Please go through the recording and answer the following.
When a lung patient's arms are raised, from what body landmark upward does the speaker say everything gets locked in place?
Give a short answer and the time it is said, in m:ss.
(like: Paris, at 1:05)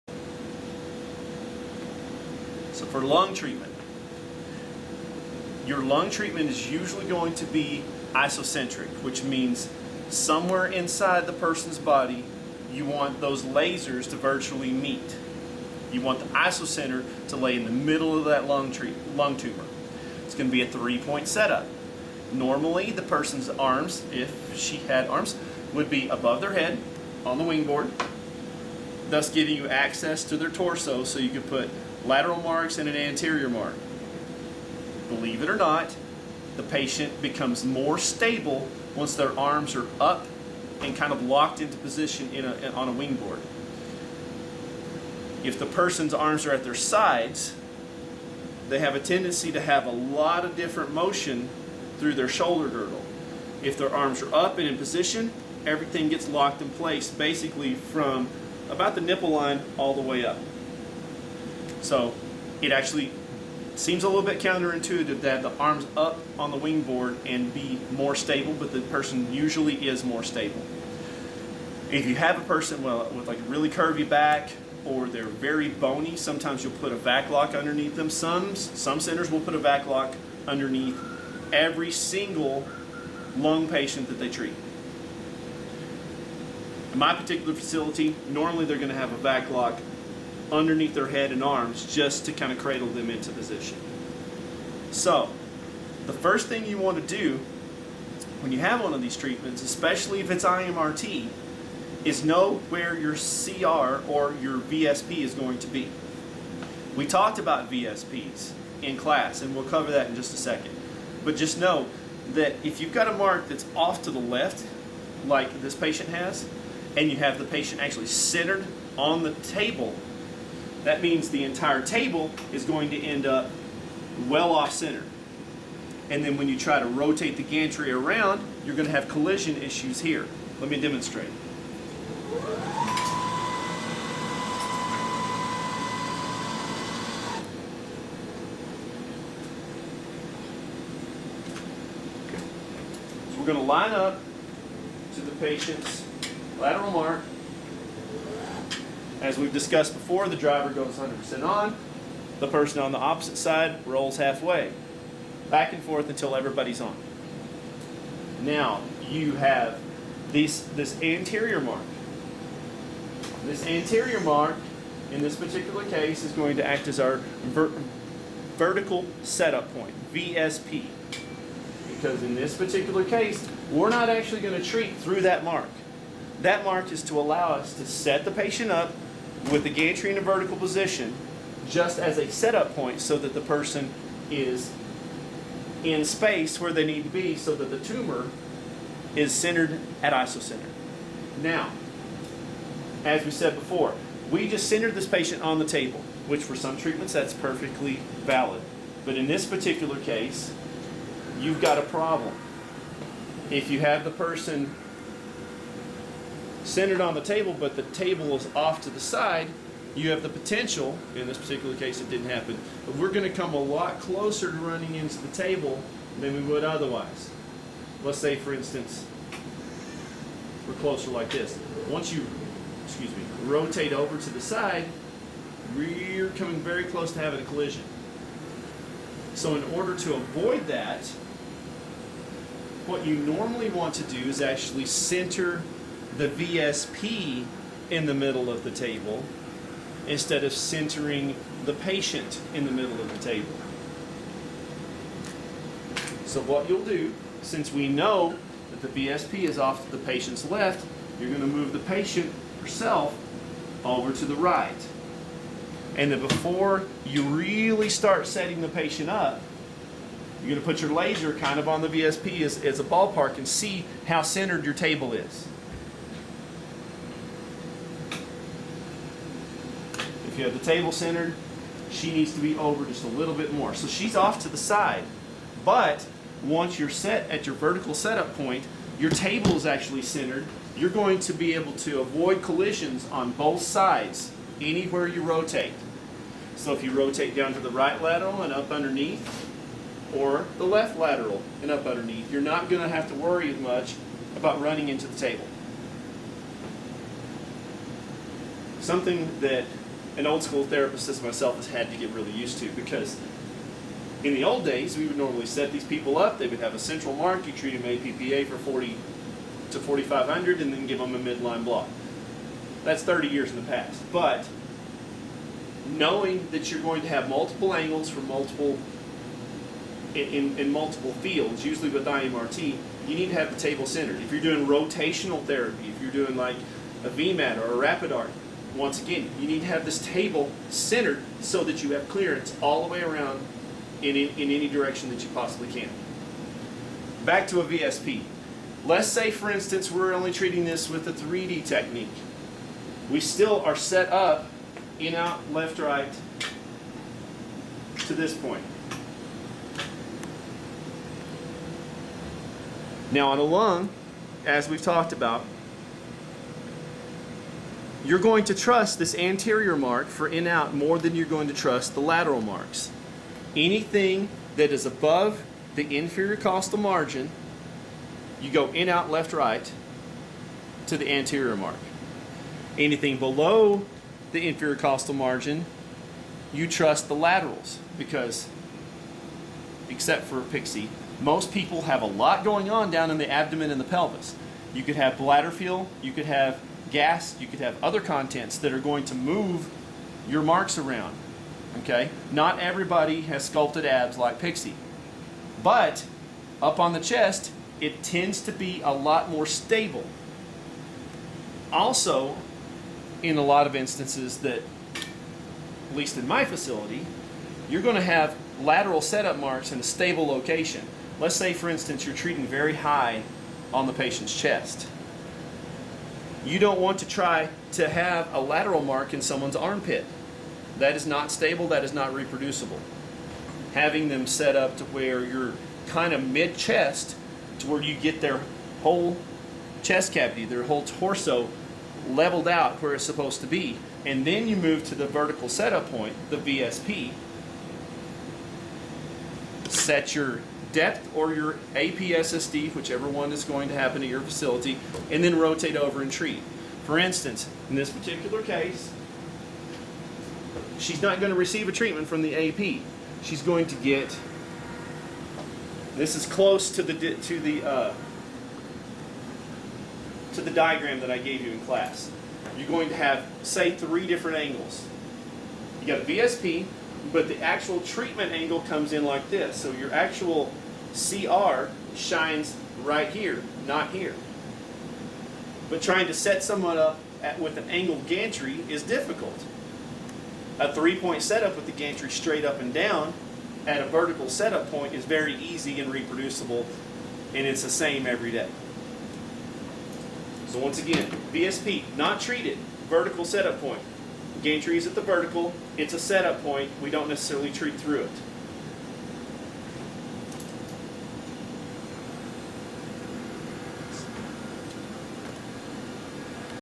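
nipple line, at 0:59.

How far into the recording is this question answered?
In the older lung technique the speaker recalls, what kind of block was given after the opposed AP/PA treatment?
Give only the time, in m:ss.
5:11.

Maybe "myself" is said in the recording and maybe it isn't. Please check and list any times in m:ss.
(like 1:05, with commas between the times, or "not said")
5:01.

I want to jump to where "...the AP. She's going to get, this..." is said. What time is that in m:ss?
7:32.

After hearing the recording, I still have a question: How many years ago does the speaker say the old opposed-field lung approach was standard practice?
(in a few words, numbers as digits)
30 years.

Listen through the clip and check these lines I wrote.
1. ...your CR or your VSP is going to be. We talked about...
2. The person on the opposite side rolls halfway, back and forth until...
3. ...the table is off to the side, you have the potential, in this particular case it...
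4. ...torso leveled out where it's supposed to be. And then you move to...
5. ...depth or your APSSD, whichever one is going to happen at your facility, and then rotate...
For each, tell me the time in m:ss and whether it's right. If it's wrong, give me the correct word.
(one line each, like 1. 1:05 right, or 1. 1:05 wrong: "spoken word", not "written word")
1. 1:42 right
2. 2:32 right
3. 3:27 right
4. 7:10 right
5. 7:20 right.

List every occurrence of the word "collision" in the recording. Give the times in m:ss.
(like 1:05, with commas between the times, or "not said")
2:09, 3:47, 4:42.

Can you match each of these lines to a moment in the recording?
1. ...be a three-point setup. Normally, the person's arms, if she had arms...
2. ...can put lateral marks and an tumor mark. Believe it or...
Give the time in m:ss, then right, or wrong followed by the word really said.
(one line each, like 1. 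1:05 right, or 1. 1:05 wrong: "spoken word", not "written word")
1. 0:20 right
2. 0:31 wrong: "anterior", not "tumor".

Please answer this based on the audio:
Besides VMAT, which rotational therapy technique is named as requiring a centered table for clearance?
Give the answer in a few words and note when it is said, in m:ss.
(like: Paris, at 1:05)
RapidArc, at 5:27.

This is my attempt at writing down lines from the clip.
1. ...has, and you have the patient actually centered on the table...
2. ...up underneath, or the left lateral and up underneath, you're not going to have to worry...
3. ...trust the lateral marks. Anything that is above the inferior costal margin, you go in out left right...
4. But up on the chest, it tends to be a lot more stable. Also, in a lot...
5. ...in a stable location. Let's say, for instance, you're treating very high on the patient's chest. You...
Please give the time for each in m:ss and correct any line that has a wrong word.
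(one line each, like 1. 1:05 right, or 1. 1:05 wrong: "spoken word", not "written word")
1. 1:56 right
2. 4:48 right
3. 6:01 right
4. 6:35 right
5. 6:49 right.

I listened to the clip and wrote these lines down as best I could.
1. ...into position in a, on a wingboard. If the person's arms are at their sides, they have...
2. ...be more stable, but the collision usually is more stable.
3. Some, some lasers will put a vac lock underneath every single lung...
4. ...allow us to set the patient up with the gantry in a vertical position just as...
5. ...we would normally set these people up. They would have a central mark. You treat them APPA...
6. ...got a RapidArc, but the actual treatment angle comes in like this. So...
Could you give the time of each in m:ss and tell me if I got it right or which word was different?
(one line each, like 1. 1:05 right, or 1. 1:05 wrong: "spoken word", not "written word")
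1. 0:41 right
2. 1:07 wrong: "person", not "collision"
3. 1:18 wrong: "centers", not "lasers"
4. 2:57 right
5. 5:04 right
6. 7:45 wrong: "VSP", not "RapidArc".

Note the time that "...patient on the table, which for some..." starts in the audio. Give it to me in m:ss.
3:15.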